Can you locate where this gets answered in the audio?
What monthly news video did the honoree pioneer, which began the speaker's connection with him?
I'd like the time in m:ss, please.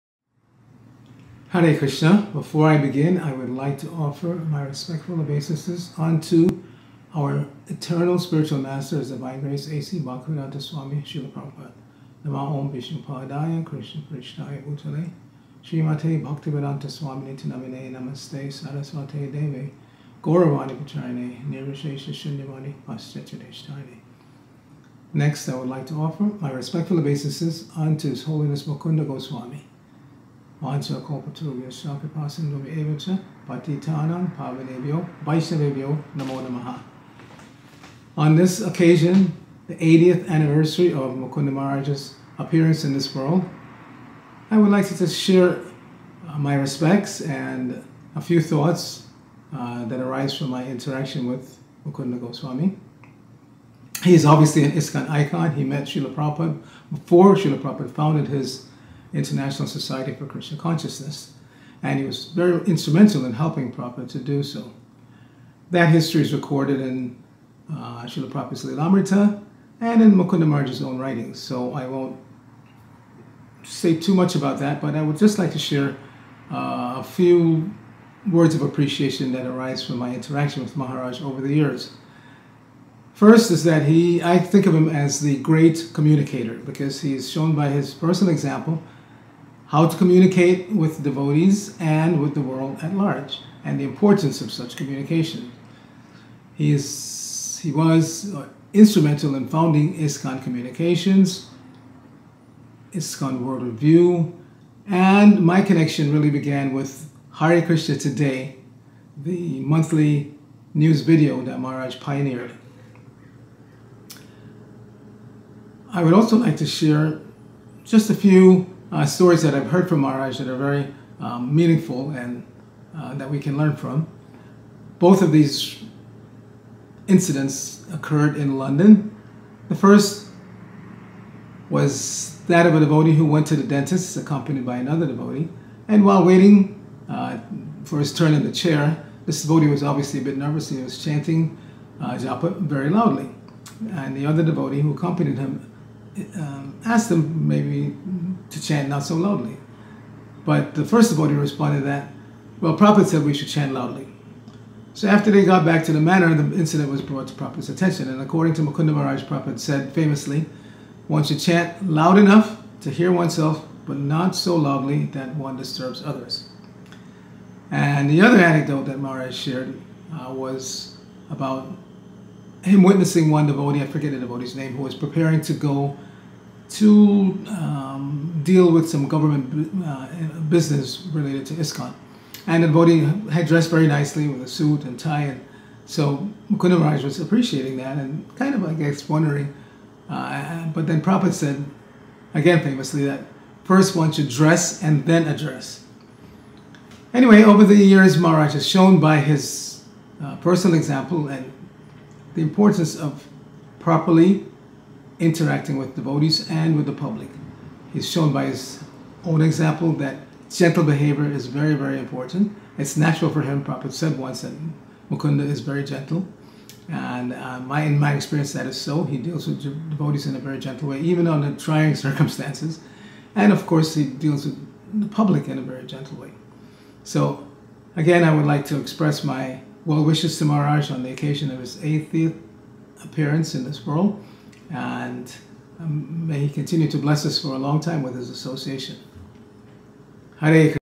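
1:47.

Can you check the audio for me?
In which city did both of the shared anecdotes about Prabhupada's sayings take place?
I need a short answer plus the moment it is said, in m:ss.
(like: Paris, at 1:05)
London, at 2:08.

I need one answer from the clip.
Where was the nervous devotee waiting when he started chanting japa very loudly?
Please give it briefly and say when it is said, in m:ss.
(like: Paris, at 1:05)
the dentist, at 2:13.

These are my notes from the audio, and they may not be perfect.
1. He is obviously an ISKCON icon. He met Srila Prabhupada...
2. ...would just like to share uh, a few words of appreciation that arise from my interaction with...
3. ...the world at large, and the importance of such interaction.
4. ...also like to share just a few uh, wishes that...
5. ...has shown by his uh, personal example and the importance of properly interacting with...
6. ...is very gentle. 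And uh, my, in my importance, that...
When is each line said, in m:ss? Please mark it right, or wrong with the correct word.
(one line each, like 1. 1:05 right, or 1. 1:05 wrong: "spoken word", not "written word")
1. 0:54 right
2. 1:15 right
3. 1:32 wrong: "communication", not "interaction"
4. 1:56 wrong: "stories", not "wishes"
5. 3:18 right
6. 3:35 wrong: "experience", not "importance".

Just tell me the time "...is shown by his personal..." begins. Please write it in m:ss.
1:27.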